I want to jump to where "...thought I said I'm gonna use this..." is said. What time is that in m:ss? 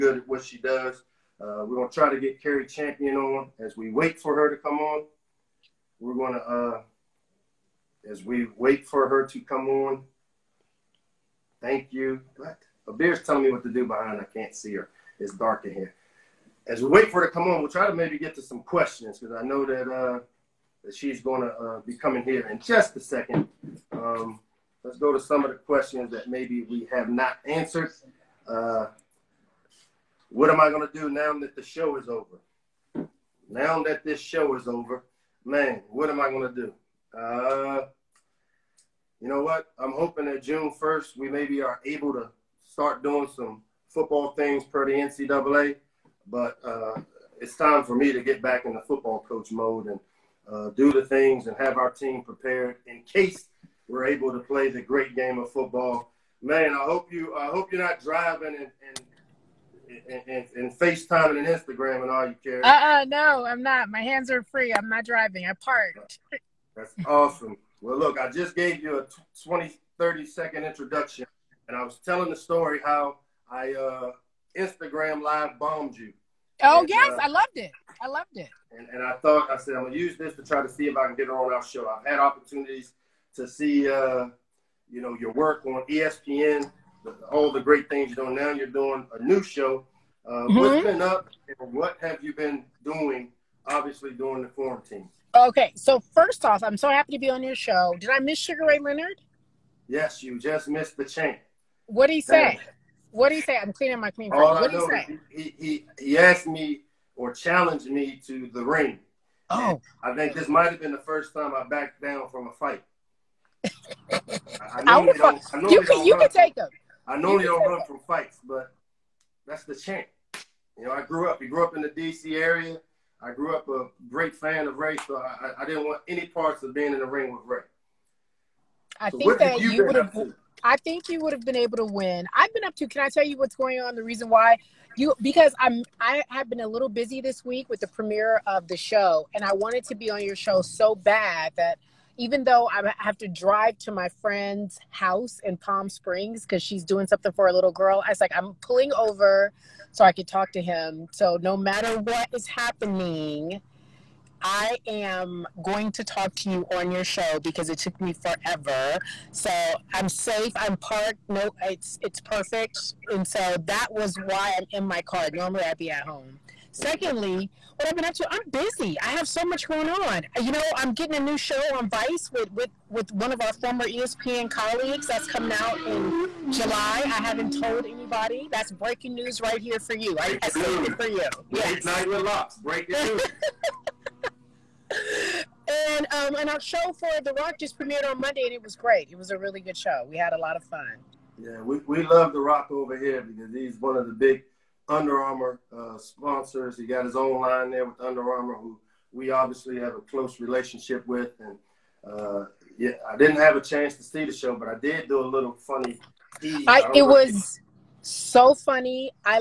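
1:19.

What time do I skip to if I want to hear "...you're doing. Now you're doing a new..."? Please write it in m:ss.
1:28.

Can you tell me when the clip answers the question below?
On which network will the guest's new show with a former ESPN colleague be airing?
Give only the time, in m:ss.
2:51.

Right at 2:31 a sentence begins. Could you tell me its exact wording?
So no matter what is happening, I am going to talk to you on your show because it took me forever.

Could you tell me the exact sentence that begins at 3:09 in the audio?
It was a really good show.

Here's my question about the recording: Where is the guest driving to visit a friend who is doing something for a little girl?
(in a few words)
Palm Springs.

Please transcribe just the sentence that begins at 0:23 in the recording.
Um, let's go to some of the questions that maybe we have not answered.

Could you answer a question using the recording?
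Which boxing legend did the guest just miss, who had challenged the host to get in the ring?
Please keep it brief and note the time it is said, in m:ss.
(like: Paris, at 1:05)
Sugar Ray Leonard, at 1:38.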